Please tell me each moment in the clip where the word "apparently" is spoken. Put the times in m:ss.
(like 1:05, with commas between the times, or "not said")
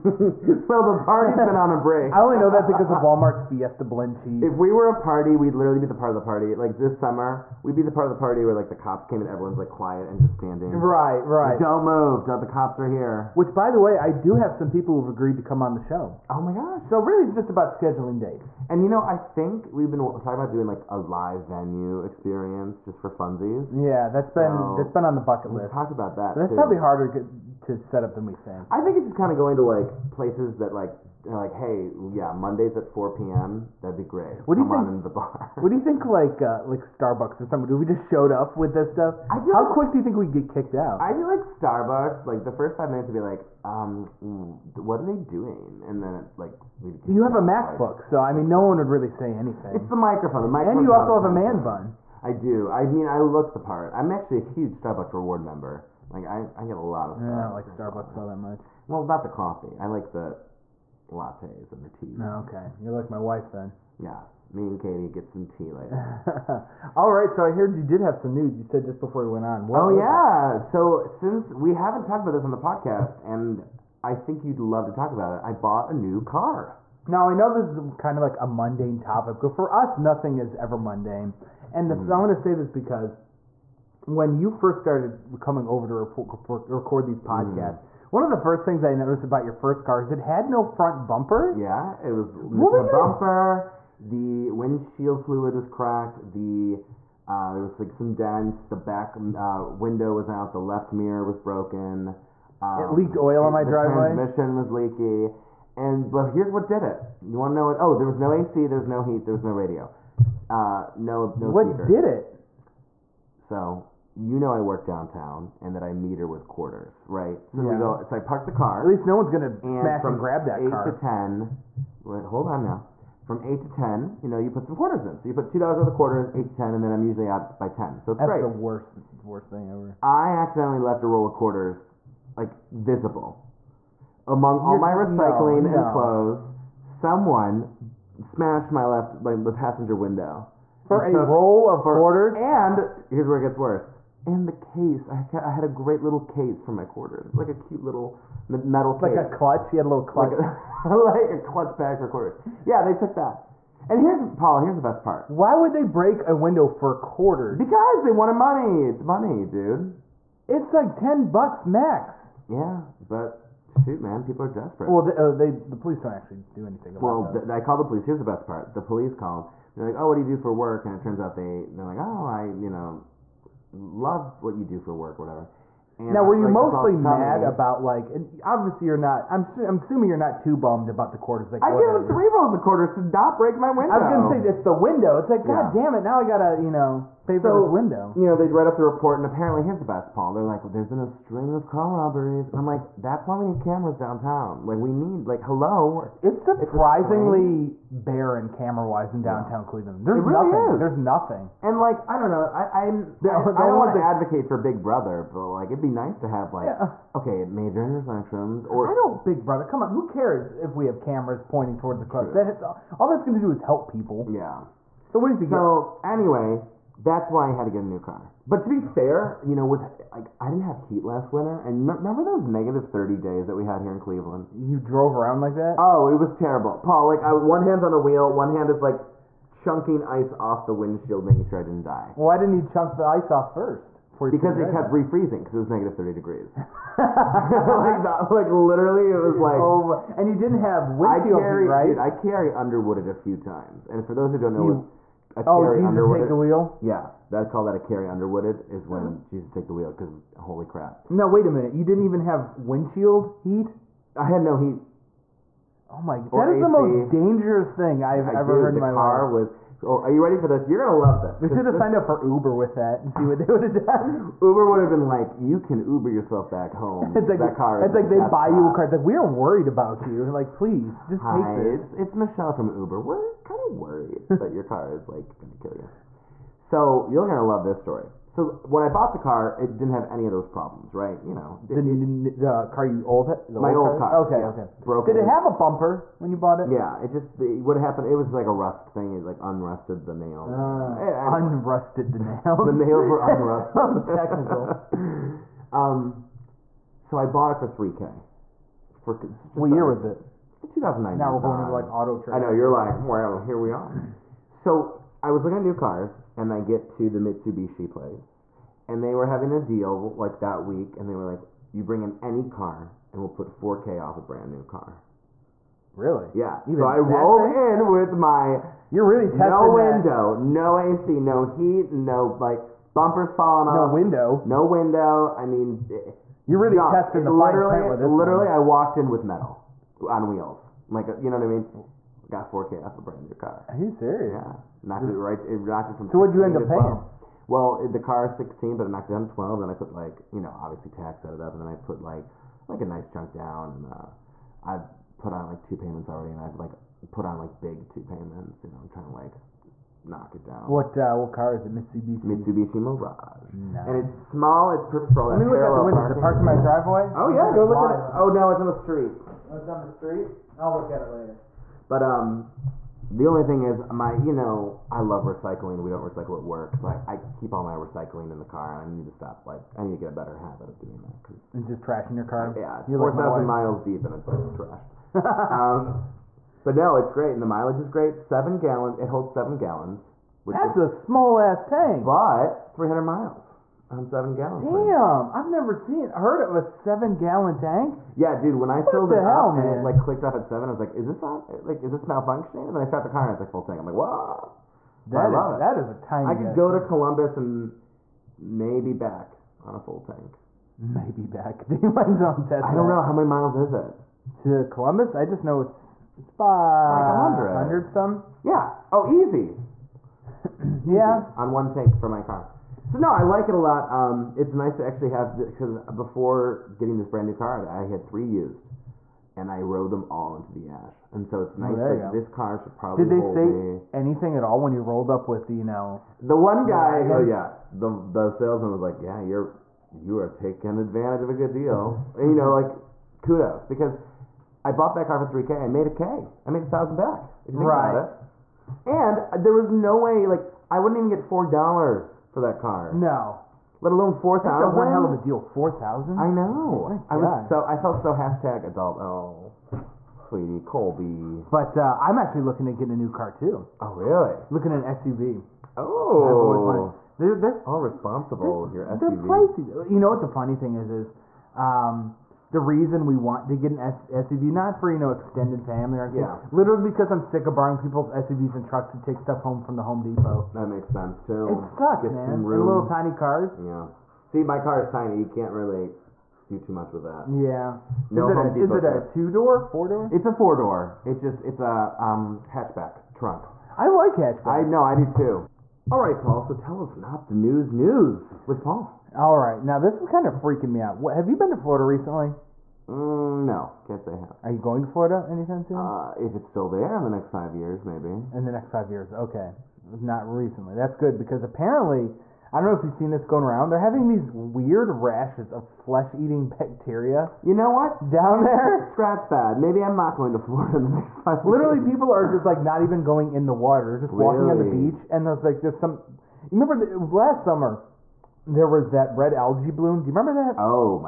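3:09, 8:21.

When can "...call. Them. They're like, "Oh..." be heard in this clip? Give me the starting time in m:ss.
2:49.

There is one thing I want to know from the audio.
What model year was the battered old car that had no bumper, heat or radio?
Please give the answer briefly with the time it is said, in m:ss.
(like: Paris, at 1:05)
2009, at 5:00.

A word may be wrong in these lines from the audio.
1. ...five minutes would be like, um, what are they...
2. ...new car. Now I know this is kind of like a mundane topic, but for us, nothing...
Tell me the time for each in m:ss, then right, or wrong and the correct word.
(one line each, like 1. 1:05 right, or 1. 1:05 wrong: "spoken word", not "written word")
1. 0:42 right
2. 1:15 right.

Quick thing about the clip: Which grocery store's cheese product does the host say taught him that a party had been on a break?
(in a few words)
Walmart.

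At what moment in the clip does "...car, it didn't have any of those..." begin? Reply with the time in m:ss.
4:39.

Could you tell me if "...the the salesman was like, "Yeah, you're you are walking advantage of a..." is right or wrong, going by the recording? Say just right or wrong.
wrong.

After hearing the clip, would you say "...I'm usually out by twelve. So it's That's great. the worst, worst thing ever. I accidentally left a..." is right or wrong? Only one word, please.
wrong.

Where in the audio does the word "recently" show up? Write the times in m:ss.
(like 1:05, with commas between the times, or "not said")
8:11, 8:20.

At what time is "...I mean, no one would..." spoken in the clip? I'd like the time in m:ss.
0:48.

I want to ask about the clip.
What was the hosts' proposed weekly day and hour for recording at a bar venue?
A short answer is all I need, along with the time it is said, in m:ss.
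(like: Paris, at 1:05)
Mondays at 4 p.m., at 0:32.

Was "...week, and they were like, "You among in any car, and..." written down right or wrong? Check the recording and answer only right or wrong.
wrong.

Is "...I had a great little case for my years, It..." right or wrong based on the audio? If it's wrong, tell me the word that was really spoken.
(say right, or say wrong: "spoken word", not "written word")
wrong: "quarters", not "years".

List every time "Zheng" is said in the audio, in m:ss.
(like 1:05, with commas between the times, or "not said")
not said.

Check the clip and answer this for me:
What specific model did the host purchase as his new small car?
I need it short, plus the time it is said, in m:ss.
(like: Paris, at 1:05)
Mirage, at 5:52.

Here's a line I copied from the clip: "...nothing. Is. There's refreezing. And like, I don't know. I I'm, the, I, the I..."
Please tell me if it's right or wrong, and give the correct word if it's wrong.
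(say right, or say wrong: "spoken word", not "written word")
wrong: "nothing", not "refreezing".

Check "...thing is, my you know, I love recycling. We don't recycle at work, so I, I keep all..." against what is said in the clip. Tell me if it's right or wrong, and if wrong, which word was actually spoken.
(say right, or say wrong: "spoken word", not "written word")
right.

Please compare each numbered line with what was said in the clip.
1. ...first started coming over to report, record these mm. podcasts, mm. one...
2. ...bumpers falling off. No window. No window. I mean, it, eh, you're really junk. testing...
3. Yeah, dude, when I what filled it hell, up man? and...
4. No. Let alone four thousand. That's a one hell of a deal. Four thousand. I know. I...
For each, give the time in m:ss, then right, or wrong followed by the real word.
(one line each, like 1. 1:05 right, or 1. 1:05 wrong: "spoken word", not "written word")
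1. 1:24 right
2. 5:22 right
3. 6:28 right
4. 7:22 right.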